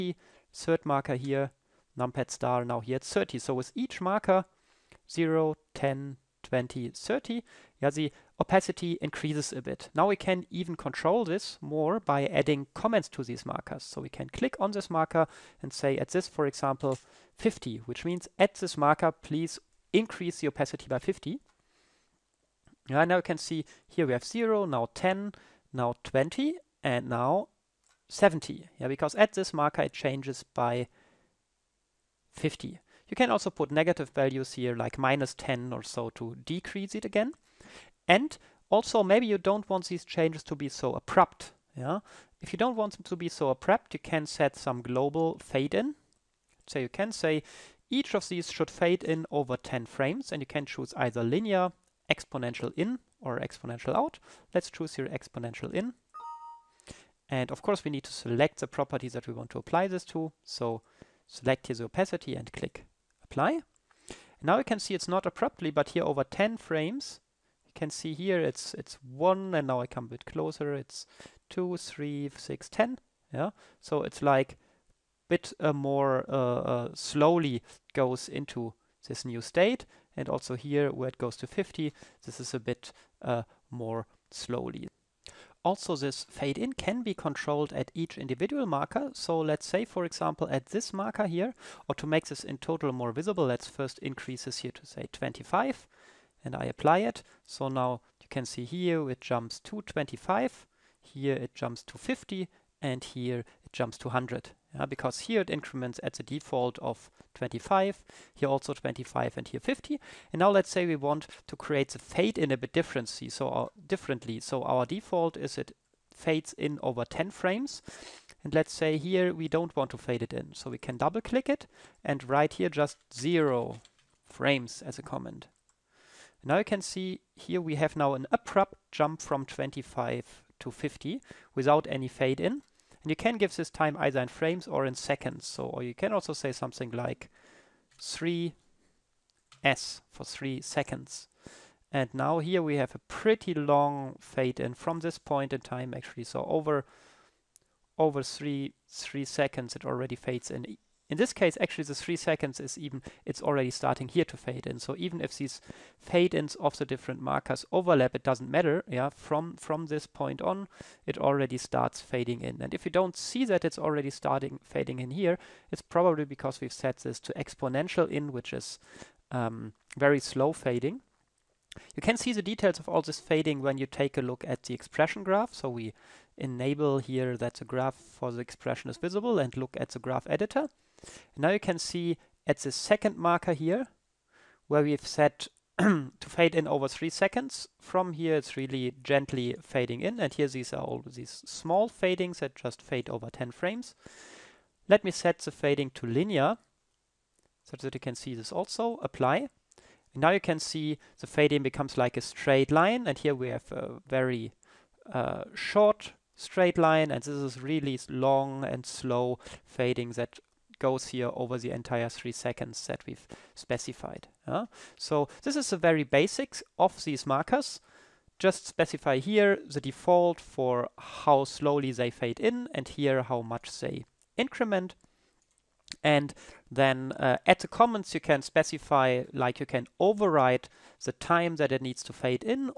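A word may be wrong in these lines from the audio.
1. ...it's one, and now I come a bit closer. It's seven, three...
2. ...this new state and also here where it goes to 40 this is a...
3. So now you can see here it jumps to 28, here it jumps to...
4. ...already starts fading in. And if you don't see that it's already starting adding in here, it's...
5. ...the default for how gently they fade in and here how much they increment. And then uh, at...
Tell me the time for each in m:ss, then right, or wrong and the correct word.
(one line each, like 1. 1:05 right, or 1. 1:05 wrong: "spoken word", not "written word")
1. 1:08 wrong: "two", not "seven"
2. 1:19 wrong: "50", not "40"
3. 1:37 wrong: "25", not "28"
4. 2:41 wrong: "fading", not "adding"
5. 3:39 wrong: "slowly", not "gently".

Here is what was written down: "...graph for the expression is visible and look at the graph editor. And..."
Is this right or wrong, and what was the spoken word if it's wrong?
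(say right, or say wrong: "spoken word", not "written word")
right.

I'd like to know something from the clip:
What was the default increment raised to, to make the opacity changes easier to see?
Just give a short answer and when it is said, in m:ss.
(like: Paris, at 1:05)
25, at 1:33.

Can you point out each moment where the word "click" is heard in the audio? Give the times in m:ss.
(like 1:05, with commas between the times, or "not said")
0:14, 1:02, 2:01.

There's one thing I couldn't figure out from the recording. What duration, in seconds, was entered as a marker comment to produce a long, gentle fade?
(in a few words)
3s.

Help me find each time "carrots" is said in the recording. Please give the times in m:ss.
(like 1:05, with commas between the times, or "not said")
not said.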